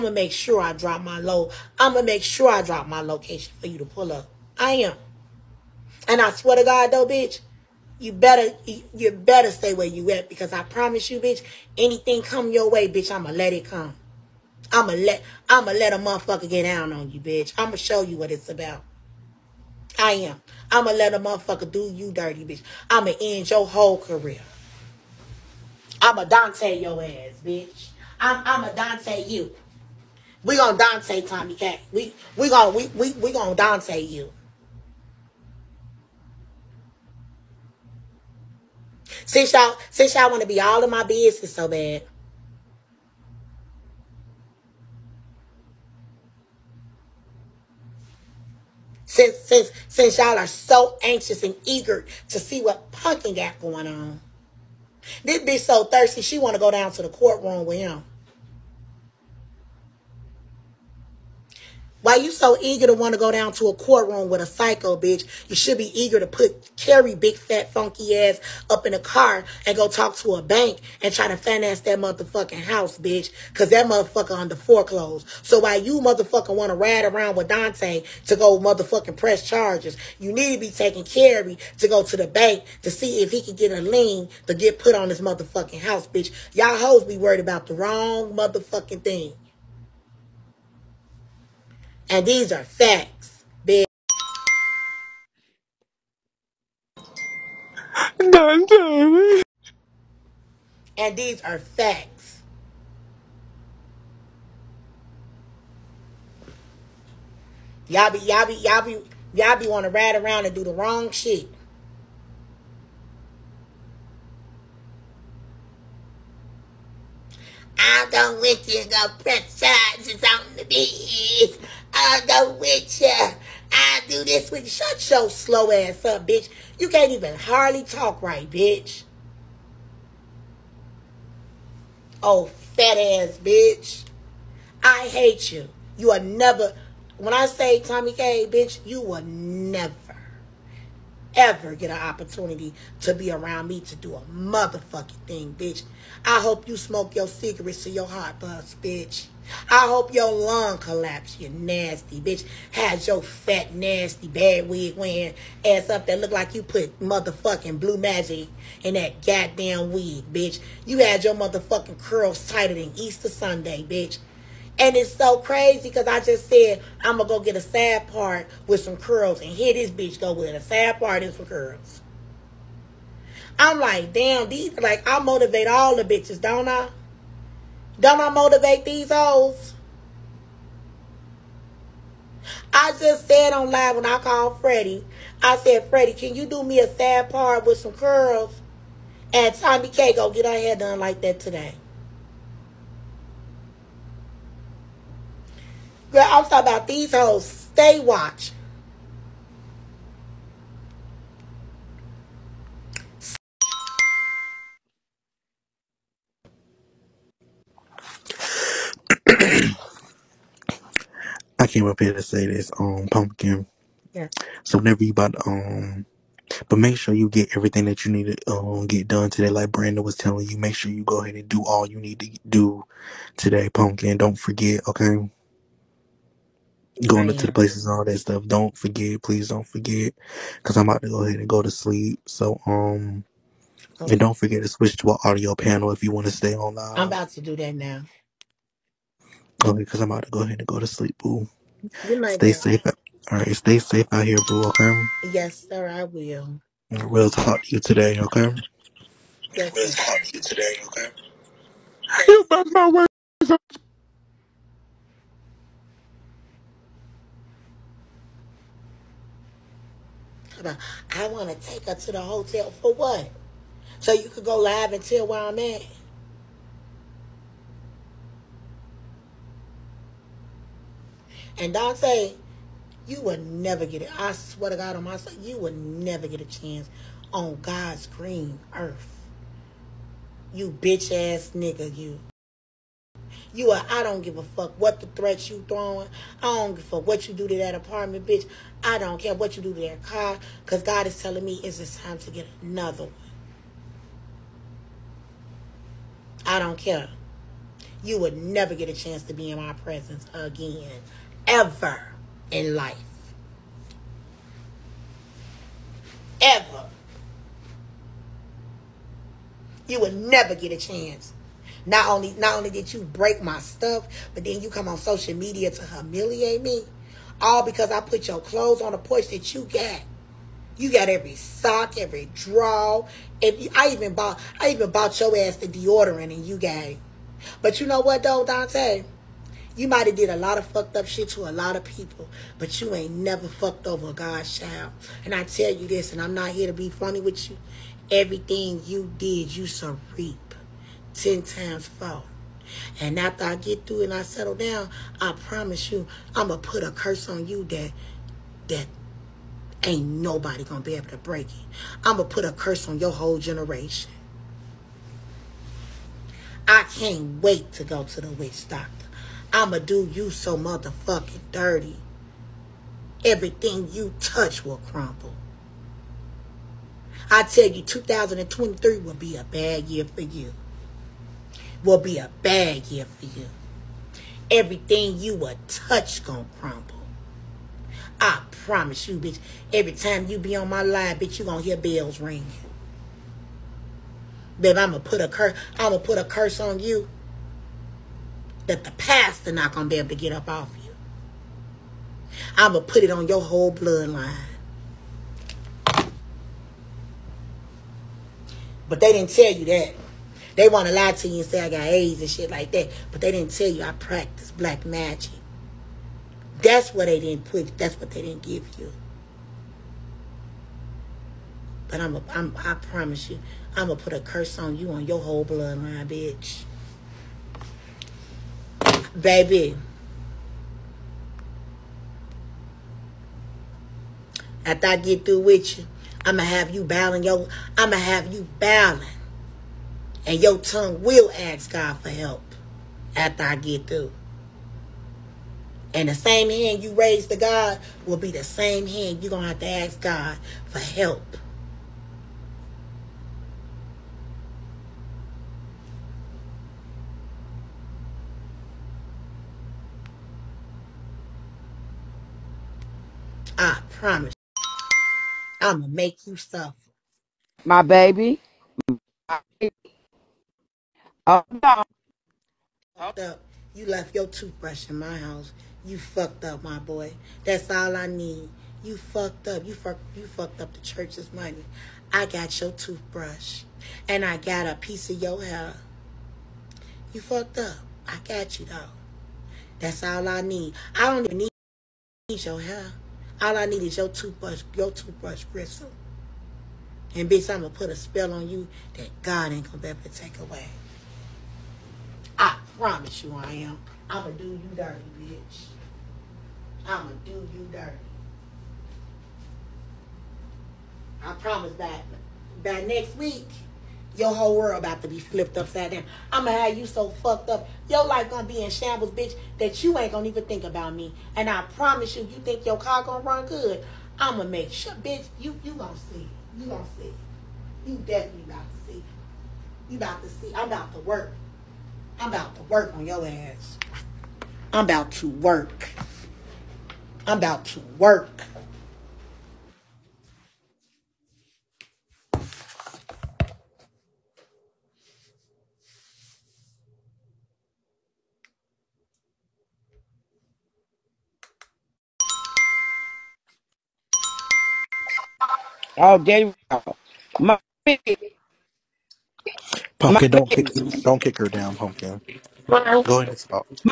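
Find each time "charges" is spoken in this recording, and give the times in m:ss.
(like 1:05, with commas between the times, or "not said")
1:19, 1:59.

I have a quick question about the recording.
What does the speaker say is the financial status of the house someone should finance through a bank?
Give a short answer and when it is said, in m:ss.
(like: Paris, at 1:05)
foreclosed, at 1:14.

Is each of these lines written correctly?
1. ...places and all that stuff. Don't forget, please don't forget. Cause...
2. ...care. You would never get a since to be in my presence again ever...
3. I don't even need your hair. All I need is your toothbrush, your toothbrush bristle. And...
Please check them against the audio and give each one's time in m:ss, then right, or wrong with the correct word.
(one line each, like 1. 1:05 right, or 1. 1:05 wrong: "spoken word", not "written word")
1. 3:47 right
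2. 4:56 wrong: "chance", not "since"
3. 8:00 right.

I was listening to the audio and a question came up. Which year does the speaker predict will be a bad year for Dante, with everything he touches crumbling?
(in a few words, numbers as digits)
2023.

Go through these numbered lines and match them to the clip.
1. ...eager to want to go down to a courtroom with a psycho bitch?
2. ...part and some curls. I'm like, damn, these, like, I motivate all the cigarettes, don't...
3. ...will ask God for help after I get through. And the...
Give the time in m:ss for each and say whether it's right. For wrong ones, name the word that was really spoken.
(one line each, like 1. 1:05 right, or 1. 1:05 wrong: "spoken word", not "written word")
1. 1:02 right
2. 2:50 wrong: "bitches", not "cigarettes"
3. 7:11 right.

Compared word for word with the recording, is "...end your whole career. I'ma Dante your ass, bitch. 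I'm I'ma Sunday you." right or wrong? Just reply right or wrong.
wrong.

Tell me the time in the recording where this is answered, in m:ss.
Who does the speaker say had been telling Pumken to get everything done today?
3:39.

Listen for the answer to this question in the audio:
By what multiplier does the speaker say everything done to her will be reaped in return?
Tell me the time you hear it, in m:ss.
5:41.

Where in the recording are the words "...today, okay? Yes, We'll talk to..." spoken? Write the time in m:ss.
4:07.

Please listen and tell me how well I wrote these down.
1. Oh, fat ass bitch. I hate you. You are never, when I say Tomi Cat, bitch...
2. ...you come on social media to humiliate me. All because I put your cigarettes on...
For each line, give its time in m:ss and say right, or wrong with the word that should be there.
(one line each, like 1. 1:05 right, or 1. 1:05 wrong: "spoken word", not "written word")
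1. 2:12 wrong: "Kay", not "Cat"
2. 5:14 wrong: "clothes", not "cigarettes".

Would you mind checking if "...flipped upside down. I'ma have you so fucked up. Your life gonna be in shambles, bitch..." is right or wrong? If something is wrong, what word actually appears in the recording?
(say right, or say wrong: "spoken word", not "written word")
right.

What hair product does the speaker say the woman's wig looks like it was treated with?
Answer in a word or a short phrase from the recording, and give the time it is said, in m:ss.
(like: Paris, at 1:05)
Blue Magic, at 2:37.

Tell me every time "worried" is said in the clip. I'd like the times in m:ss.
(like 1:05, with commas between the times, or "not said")
1:27.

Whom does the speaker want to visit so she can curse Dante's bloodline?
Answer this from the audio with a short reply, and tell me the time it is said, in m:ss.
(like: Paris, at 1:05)
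the witch doctor, at 5:58.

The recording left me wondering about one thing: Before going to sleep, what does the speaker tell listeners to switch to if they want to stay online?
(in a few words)
audio panel.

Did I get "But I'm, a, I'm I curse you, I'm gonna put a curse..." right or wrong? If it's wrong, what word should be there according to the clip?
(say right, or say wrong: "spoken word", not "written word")
wrong: "promise", not "curse".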